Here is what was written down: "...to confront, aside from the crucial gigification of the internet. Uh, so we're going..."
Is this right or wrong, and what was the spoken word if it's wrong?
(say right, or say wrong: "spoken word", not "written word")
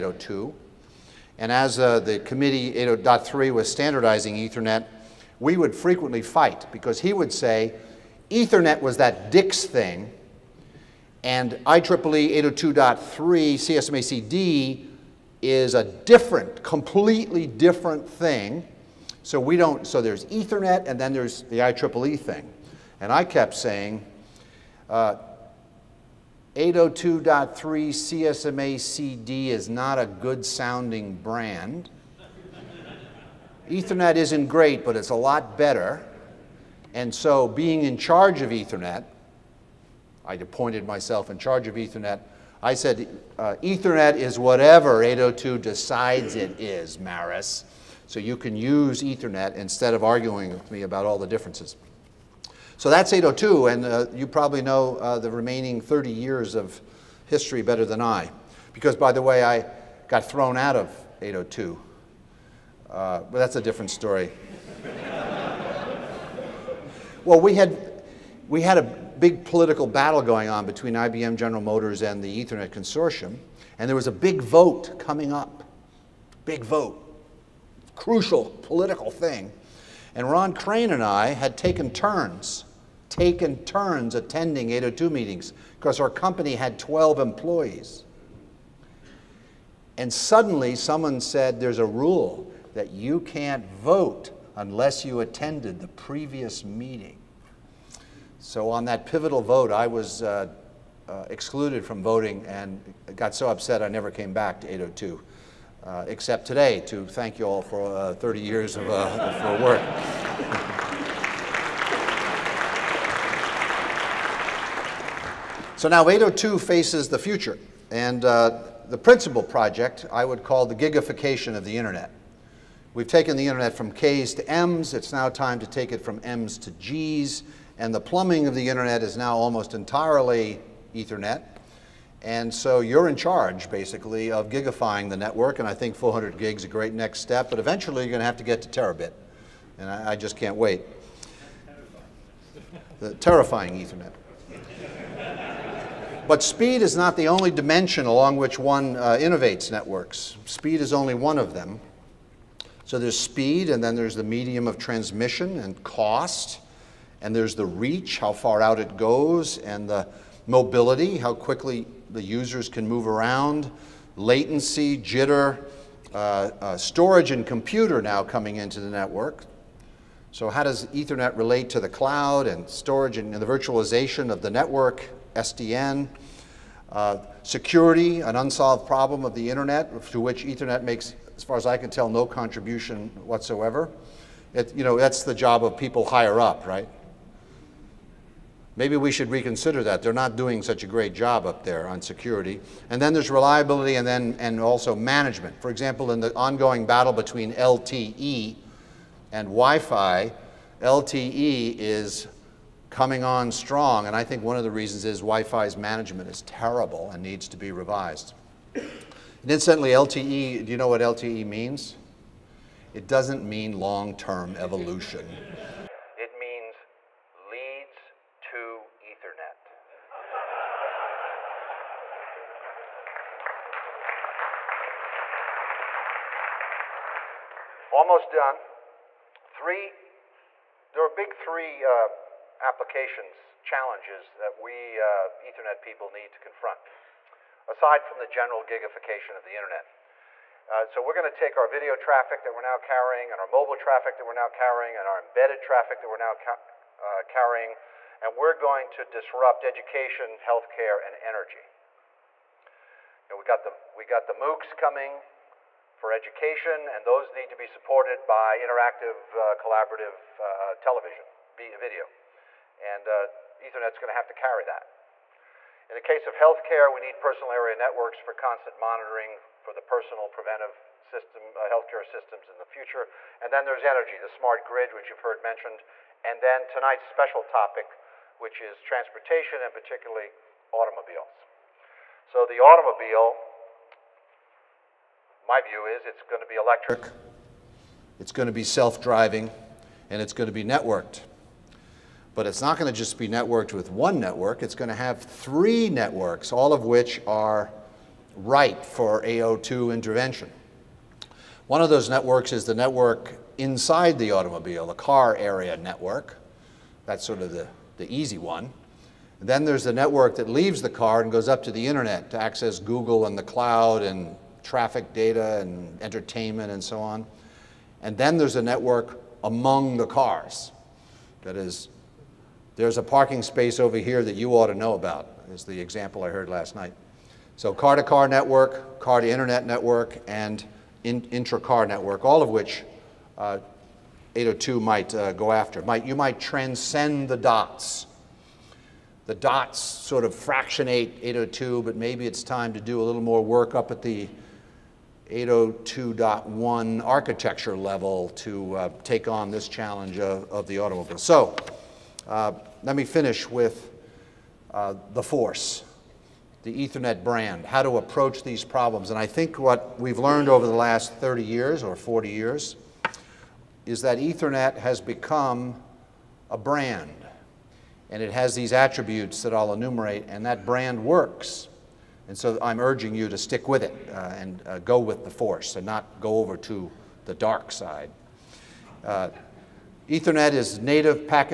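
wrong: "general", not "crucial".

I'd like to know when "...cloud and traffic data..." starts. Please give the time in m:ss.
5:13.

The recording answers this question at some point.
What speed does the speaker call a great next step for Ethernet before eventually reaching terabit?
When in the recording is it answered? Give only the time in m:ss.
2:15.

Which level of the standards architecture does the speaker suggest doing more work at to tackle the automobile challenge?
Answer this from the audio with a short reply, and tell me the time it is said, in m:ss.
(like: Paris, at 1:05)
802.1, at 5:45.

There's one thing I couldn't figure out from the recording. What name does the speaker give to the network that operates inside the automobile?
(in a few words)
car area network.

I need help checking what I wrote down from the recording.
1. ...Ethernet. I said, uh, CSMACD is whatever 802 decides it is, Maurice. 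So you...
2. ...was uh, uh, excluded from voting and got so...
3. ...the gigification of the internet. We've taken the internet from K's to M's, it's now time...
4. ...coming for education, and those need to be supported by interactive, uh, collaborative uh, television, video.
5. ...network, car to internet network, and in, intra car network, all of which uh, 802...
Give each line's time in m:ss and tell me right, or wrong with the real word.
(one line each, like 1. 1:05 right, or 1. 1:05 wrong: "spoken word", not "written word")
1. 0:41 wrong: "Ethernet", not "CSMACD"
2. 1:39 right
3. 2:00 right
4. 4:14 right
5. 5:28 right.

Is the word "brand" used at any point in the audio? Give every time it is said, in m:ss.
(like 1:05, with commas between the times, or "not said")
0:31, 5:57, 6:06, 6:10.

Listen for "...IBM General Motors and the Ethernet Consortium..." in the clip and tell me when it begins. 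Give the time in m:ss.
1:10.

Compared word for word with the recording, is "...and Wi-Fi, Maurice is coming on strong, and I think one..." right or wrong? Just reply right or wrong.
wrong.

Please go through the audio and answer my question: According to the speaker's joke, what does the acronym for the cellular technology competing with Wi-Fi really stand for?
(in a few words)
leads to Ethernet.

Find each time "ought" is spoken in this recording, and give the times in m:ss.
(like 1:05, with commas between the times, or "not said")
5:24.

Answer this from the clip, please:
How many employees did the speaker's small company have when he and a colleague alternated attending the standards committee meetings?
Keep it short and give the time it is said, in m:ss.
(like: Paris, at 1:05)
12, at 1:26.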